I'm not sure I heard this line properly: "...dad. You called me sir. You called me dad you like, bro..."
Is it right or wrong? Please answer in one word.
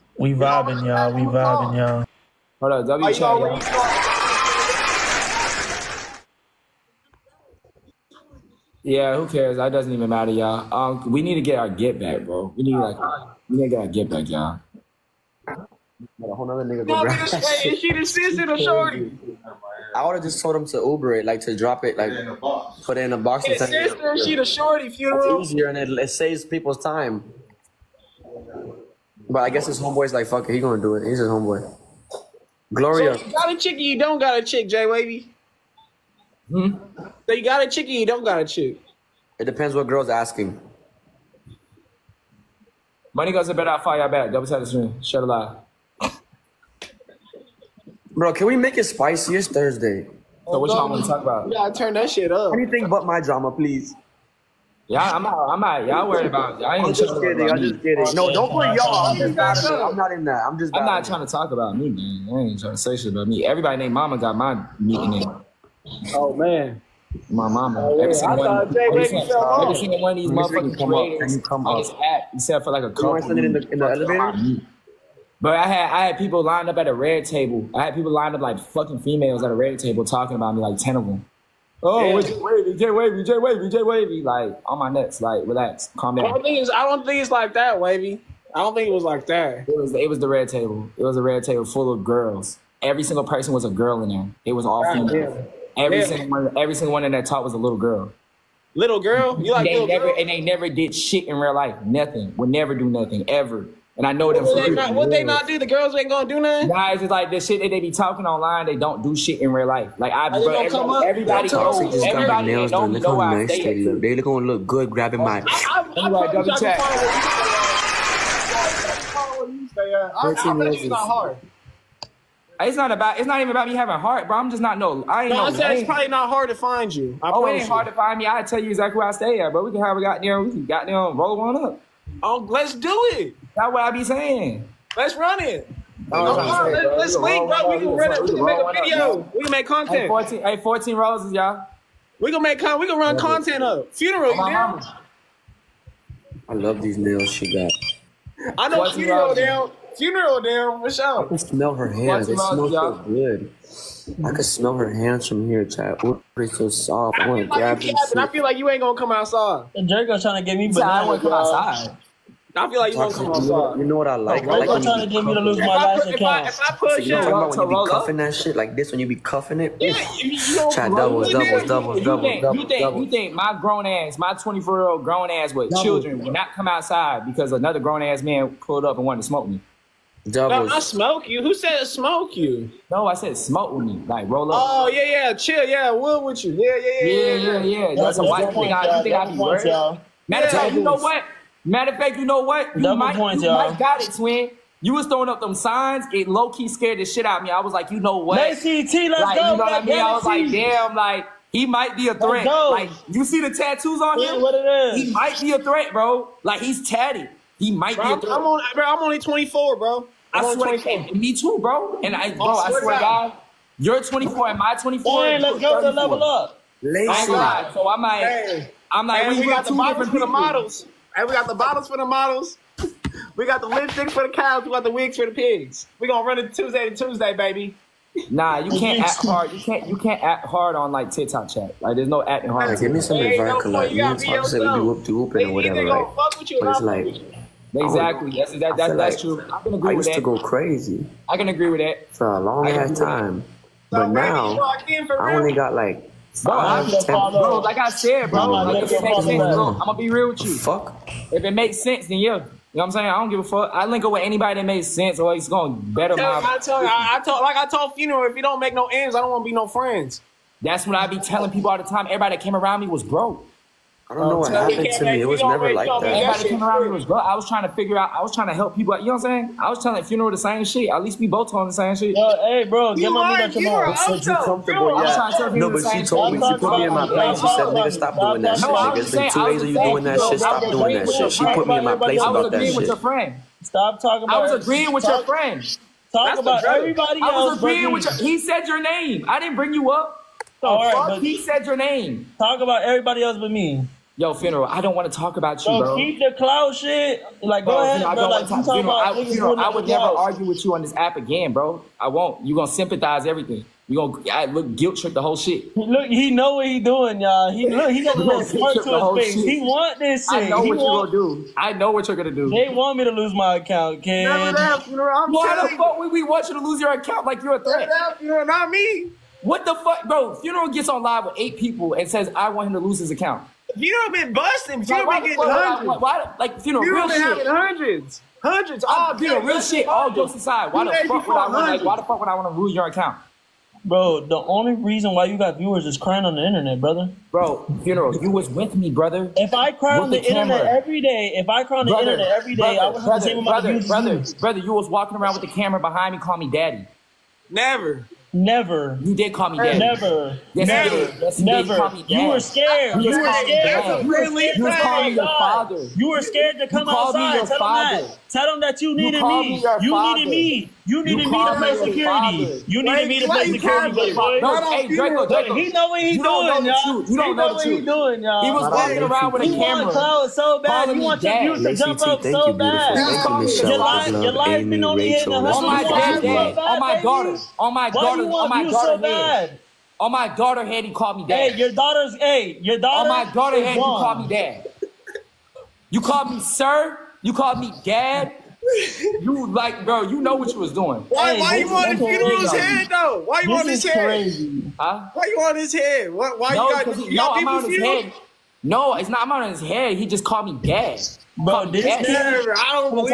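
right.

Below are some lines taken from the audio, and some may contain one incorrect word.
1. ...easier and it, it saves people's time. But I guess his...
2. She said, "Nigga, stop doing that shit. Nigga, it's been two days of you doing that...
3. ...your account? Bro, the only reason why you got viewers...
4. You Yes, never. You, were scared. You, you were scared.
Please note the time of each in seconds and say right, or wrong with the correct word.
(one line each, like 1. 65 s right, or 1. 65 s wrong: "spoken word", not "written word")
1. 25 s right
2. 277 s right
3. 332 s right
4. 350 s right.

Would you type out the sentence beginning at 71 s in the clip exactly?
I just except for like a couple.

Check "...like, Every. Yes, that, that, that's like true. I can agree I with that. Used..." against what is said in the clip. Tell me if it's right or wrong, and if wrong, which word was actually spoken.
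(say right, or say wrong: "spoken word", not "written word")
wrong: "Exactly", not "Every".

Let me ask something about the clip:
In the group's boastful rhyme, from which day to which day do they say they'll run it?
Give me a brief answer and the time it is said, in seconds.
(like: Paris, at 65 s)
Tuesday to Tuesday, at 226 s.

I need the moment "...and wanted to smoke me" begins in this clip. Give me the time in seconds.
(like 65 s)
178 s.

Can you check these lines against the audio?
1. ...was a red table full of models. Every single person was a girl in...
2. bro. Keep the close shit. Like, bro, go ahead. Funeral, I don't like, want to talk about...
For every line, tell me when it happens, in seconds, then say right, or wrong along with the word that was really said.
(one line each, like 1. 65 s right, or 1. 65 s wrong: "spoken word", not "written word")
1. 91 s wrong: "girls", not "models"
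2. 295 s right.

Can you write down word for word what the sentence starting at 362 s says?
You need needed Wait, me to play security.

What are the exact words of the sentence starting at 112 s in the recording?
look how nice they, they look.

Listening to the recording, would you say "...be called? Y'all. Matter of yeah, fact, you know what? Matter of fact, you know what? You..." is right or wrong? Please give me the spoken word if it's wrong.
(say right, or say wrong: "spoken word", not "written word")
wrong: "worried", not "called".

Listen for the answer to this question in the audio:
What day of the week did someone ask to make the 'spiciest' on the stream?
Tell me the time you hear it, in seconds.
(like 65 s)
49 s.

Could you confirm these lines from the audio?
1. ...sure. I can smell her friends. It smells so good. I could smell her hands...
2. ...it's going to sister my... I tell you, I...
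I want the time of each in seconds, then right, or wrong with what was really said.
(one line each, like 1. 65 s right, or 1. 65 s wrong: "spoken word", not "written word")
1. 150 s wrong: "hands", not "friends"
2. 255 s wrong: "better", not "sister".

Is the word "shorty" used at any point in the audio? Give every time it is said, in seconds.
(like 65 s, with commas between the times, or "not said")
18 s, 24 s.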